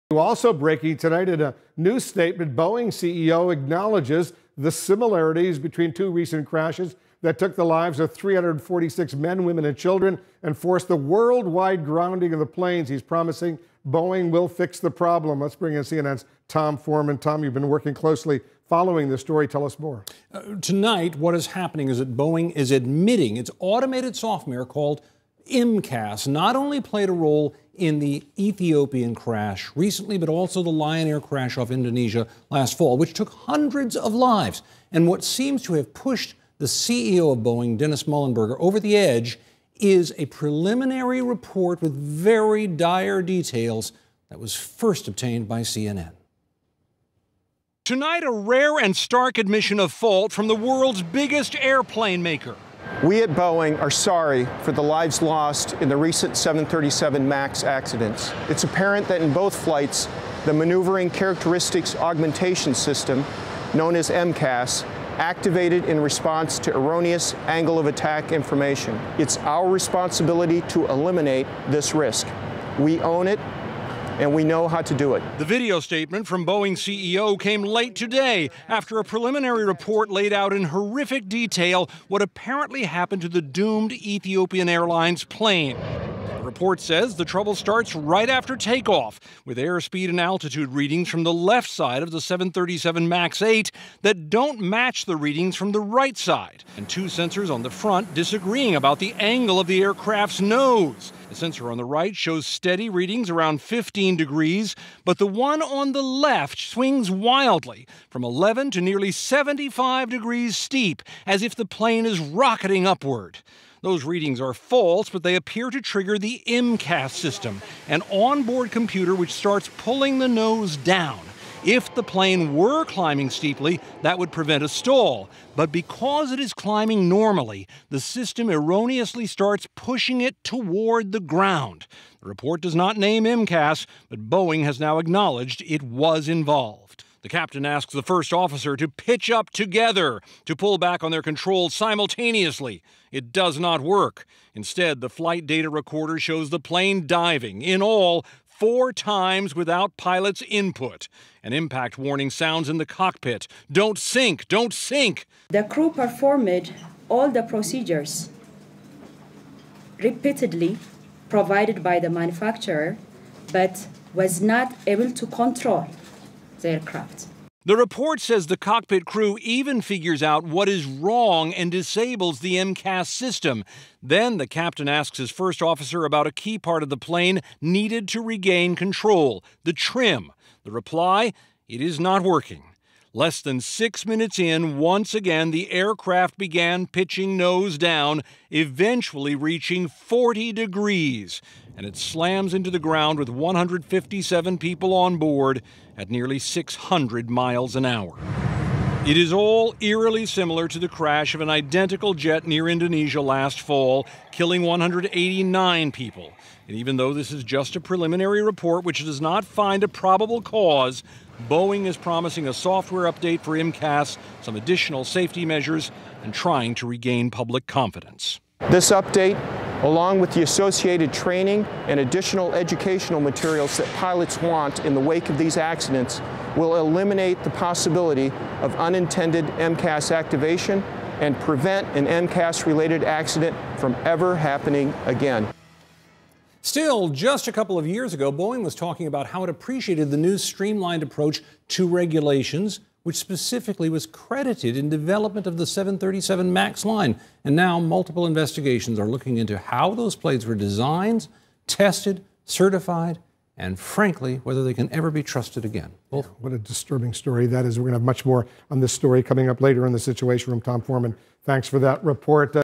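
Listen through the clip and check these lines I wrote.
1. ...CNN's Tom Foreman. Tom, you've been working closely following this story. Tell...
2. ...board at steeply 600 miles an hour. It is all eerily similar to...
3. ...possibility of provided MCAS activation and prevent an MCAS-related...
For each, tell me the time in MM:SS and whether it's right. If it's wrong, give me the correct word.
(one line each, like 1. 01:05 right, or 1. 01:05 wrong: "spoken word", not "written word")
1. 00:15 right
2. 03:15 wrong: "nearly", not "steeply"
3. 03:47 wrong: "unintended", not "provided".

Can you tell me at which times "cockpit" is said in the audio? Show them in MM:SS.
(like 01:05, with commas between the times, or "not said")
02:32, 02:48.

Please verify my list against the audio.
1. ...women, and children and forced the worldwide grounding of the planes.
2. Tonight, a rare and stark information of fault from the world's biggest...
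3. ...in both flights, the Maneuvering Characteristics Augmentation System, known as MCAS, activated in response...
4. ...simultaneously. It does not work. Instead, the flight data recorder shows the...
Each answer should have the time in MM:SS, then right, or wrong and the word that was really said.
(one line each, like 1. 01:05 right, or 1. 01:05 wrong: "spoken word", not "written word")
1. 00:09 right
2. 00:47 wrong: "admission", not "information"
3. 00:59 right
4. 02:21 right.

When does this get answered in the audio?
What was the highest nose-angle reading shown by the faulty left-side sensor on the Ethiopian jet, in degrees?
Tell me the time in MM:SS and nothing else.
01:49.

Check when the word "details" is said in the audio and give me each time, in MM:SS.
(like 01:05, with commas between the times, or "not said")
00:43, 01:21.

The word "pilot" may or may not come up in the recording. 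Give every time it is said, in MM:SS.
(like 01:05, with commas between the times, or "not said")
02:29, 03:43.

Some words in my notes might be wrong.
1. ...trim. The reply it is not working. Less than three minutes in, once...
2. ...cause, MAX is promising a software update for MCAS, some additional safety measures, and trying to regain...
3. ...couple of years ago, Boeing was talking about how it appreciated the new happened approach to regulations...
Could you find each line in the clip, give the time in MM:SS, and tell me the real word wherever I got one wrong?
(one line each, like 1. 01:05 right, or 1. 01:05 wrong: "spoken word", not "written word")
1. 02:59 wrong: "six", not "three"
2. 03:30 wrong: "Boeing", not "MAX"
3. 03:57 wrong: "streamlined", not "happened".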